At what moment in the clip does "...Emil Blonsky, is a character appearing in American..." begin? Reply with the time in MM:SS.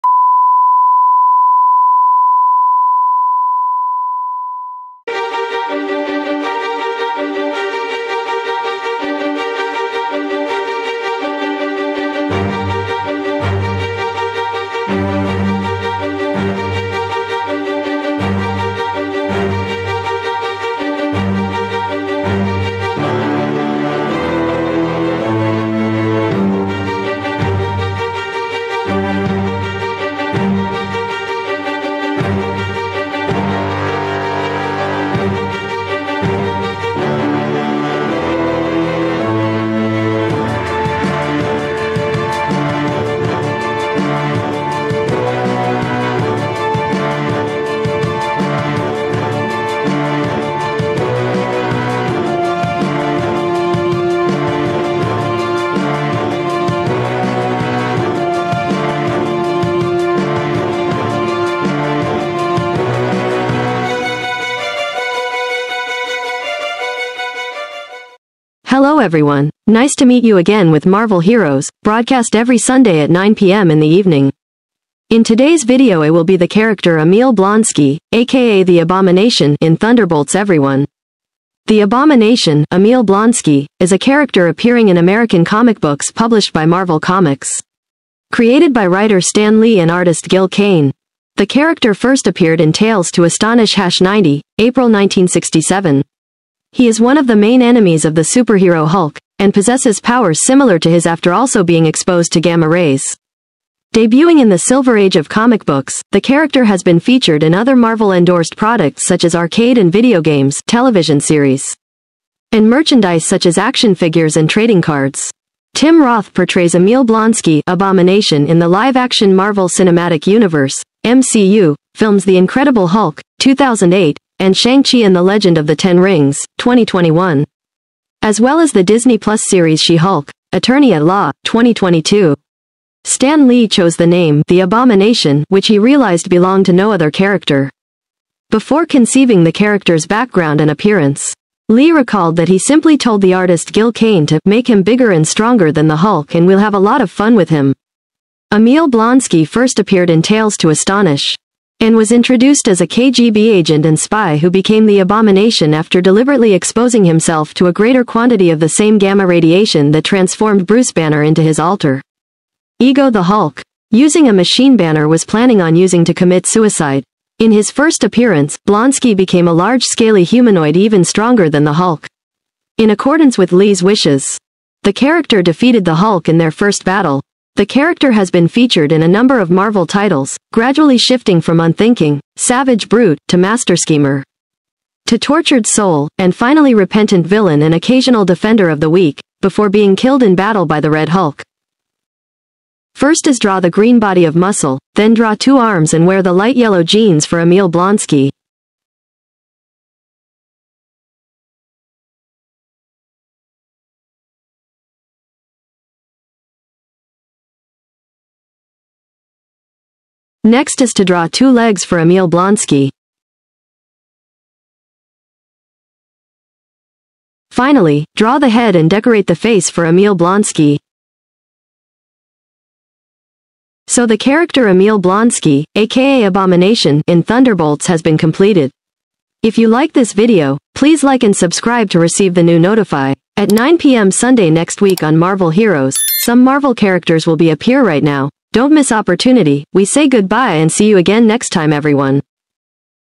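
01:22.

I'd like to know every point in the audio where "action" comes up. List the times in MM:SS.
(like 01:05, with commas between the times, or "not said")
01:53, 01:58.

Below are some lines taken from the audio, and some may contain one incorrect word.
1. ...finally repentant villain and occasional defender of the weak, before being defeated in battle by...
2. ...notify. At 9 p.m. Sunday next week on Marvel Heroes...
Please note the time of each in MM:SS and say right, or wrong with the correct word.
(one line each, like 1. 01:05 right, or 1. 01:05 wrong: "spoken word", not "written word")
1. 03:06 wrong: "killed", not "defeated"
2. 03:52 right.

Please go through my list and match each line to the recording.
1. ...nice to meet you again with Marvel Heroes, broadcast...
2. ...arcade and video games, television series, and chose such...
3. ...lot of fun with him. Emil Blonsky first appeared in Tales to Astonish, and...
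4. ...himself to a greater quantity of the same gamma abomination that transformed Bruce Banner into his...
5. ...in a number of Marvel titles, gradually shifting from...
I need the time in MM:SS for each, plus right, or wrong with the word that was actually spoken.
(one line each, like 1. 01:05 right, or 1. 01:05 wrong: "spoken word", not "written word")
1. 01:09 right
2. 01:49 wrong: "merchandise", not "chose"
3. 02:26 right
4. 02:37 wrong: "radiation", not "abomination"
5. 02:58 right.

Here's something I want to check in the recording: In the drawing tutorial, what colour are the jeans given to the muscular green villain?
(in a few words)
Light yellow.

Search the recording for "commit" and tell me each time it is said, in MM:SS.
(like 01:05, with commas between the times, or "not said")
02:46.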